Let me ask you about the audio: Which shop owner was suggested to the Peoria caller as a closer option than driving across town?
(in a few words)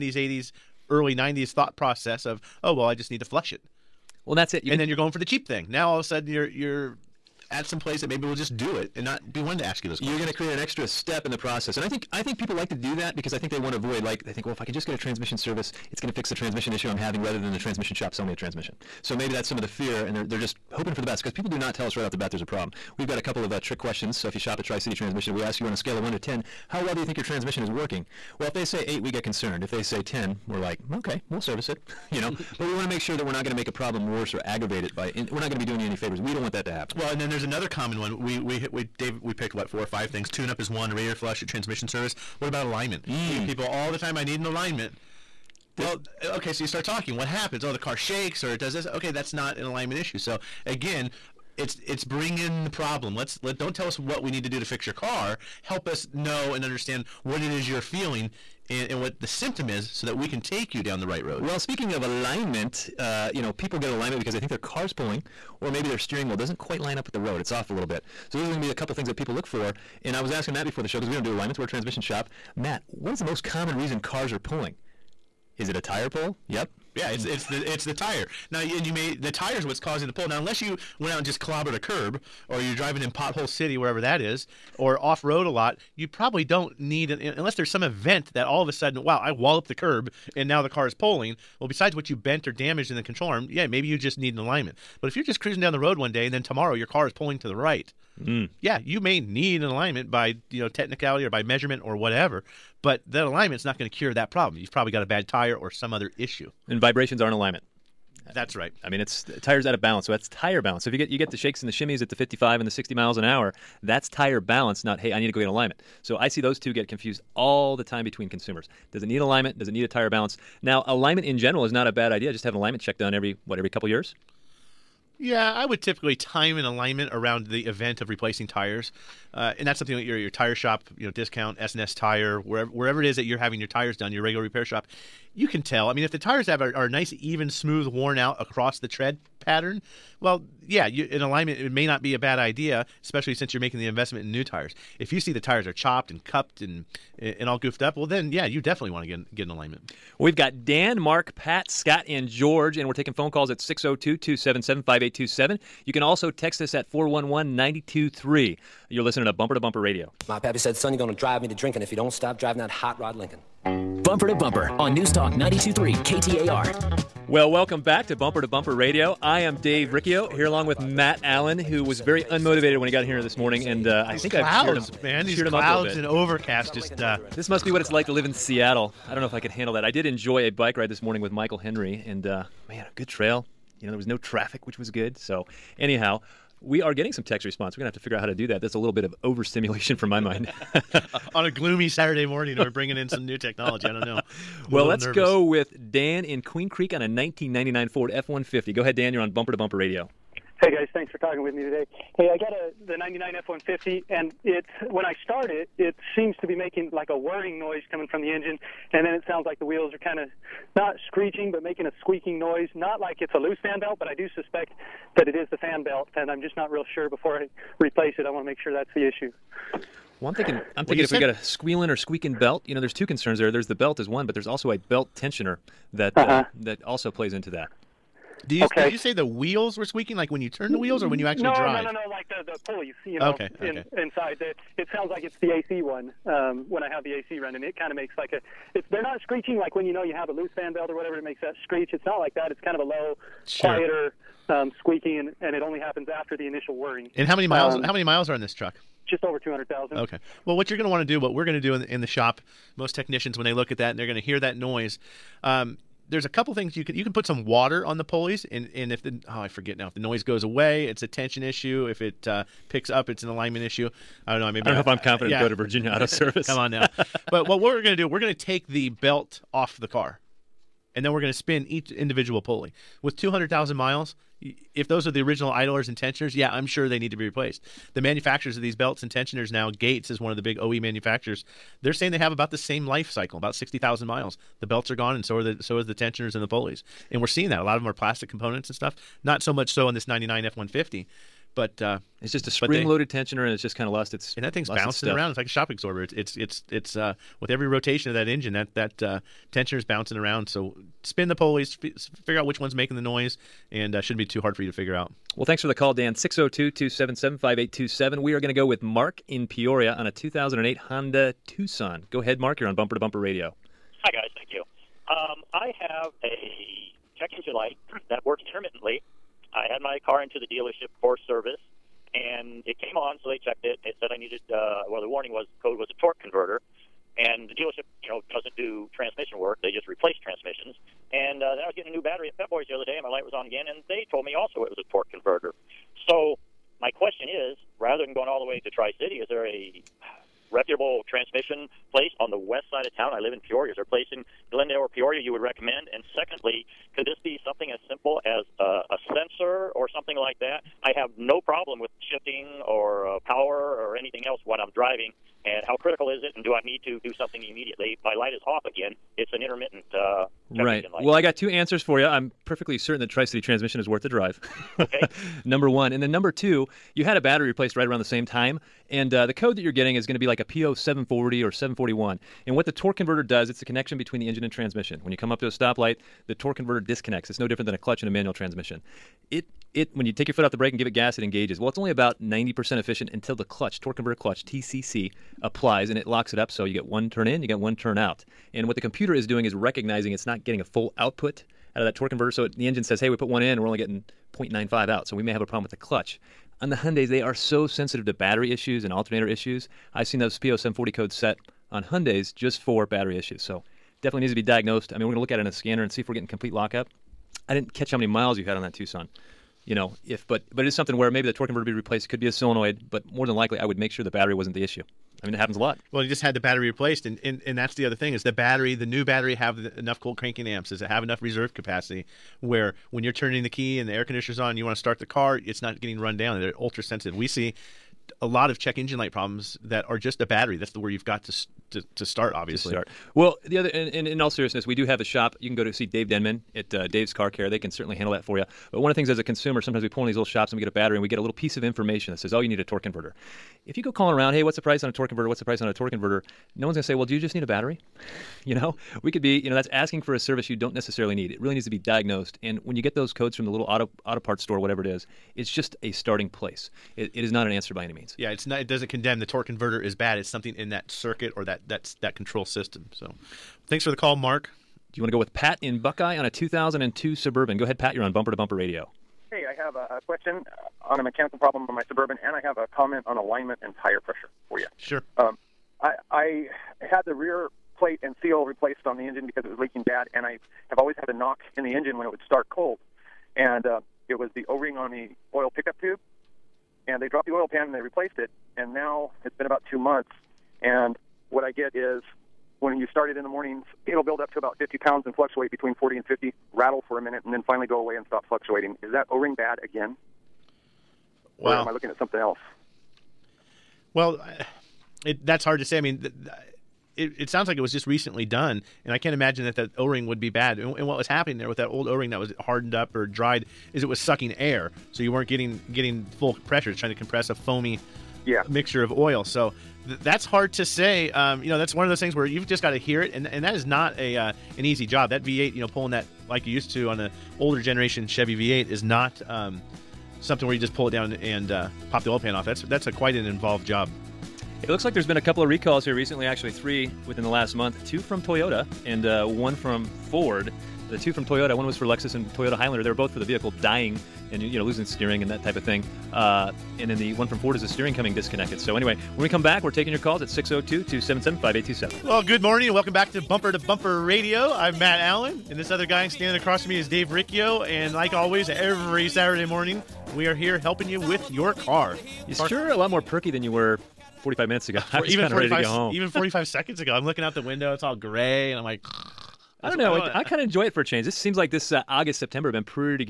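Dave Denman.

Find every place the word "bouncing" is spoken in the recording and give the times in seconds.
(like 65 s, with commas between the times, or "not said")
294 s, 299 s.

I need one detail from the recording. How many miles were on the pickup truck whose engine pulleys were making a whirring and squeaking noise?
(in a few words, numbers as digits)
Just over 200,000.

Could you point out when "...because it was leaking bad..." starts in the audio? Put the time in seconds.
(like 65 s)
479 s.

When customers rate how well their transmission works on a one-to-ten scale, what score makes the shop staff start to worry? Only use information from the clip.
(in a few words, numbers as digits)
8.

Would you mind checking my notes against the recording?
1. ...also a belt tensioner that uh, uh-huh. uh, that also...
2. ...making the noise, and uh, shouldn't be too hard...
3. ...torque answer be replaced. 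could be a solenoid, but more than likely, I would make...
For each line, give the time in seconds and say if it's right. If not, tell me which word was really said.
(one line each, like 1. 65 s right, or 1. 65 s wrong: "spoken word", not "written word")
1. 224 s right
2. 302 s right
3. 411 s wrong: "converter", not "answer".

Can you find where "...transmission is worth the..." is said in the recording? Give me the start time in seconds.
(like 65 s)
363 s.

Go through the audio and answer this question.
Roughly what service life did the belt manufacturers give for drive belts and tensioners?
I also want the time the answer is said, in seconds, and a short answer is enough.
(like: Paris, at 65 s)
60,000 miles, at 283 s.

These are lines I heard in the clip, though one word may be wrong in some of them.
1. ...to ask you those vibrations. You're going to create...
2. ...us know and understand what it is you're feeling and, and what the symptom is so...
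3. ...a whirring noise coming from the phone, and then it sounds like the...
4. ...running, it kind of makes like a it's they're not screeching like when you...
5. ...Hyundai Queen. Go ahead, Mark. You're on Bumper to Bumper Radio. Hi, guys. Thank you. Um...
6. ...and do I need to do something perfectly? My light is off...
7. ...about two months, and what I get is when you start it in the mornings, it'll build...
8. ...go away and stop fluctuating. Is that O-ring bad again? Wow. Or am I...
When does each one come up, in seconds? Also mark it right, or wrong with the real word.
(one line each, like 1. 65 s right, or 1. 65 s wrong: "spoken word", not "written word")
1. 9 s wrong: "questions", not "vibrations"
2. 55 s right
3. 207 s wrong: "engine", not "phone"
4. 237 s right
5. 310 s wrong: "Tucson", not "Queen"
6. 356 s wrong: "immediately", not "perfectly"
7. 489 s right
8. 497 s right.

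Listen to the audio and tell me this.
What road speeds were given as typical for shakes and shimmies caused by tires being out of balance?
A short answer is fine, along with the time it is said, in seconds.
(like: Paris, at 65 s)
55 and 60 mph, at 112 s.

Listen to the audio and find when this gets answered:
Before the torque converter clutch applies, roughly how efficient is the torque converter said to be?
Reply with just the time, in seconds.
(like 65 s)
382 s.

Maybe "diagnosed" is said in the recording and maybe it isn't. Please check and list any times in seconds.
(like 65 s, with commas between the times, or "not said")
404 s, 451 s.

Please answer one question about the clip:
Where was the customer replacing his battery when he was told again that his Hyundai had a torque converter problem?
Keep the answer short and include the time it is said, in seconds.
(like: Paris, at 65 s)
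Pep Boys, at 332 s.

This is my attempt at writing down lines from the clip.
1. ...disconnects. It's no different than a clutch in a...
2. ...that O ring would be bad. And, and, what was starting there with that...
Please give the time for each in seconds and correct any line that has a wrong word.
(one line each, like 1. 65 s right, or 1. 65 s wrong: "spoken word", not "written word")
1. 376 s right
2. 509 s wrong: "happening", not "starting".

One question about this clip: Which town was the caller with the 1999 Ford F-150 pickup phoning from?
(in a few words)
Queen Creek.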